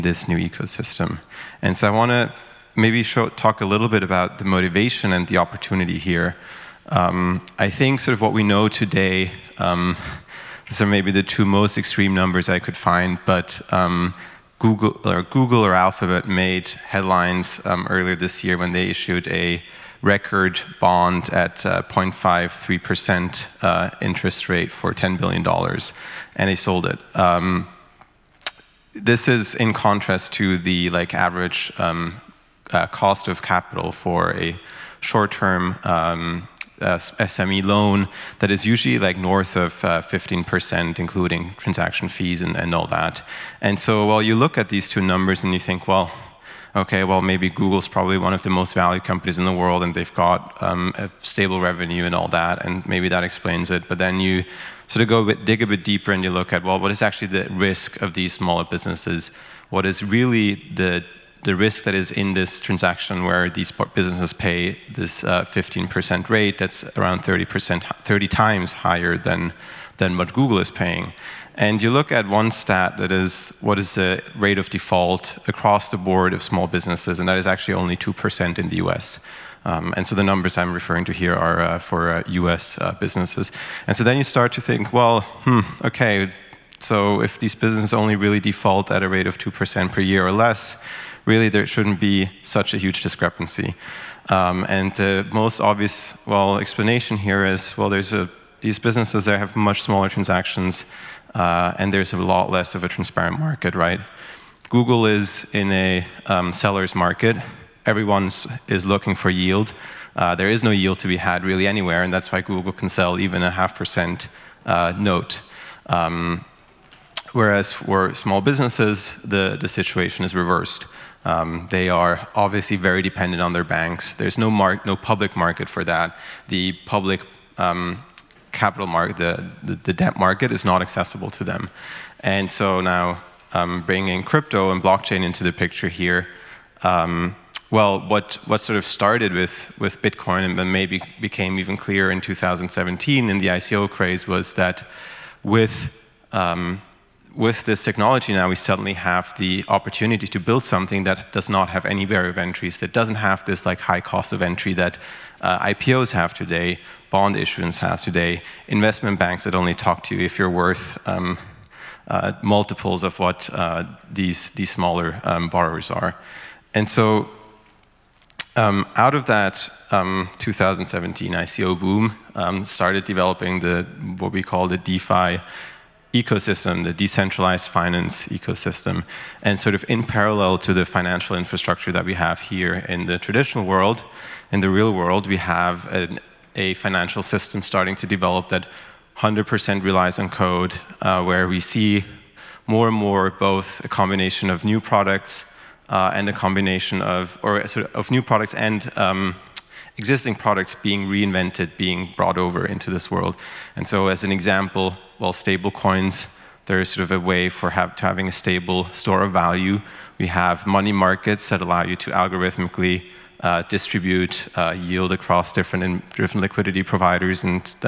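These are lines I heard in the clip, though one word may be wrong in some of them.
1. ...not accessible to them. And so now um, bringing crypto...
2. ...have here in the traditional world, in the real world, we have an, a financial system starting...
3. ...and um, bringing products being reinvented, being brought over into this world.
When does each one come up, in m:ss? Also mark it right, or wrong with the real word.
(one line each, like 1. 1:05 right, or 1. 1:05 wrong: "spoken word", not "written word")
1. 2:10 right
2. 3:02 right
3. 3:18 wrong: "existing", not "bringing".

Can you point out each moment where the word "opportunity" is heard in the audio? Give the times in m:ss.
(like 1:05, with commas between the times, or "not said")
0:05, 2:29.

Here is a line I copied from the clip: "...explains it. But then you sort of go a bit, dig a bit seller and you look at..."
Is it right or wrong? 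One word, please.
wrong.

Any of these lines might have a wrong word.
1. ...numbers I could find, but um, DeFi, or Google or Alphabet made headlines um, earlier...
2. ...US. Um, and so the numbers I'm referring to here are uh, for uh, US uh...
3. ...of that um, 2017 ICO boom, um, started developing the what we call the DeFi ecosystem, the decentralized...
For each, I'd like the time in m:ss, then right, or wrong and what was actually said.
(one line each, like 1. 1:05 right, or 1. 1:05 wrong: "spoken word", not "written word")
1. 0:12 wrong: "Google", not "DeFi"
2. 1:18 right
3. 2:49 right.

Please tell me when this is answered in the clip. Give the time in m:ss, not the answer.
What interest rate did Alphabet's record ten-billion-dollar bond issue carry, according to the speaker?
0:21.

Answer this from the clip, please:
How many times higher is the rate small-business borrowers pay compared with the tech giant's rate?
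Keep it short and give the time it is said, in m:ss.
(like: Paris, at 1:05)
30 times, at 1:08.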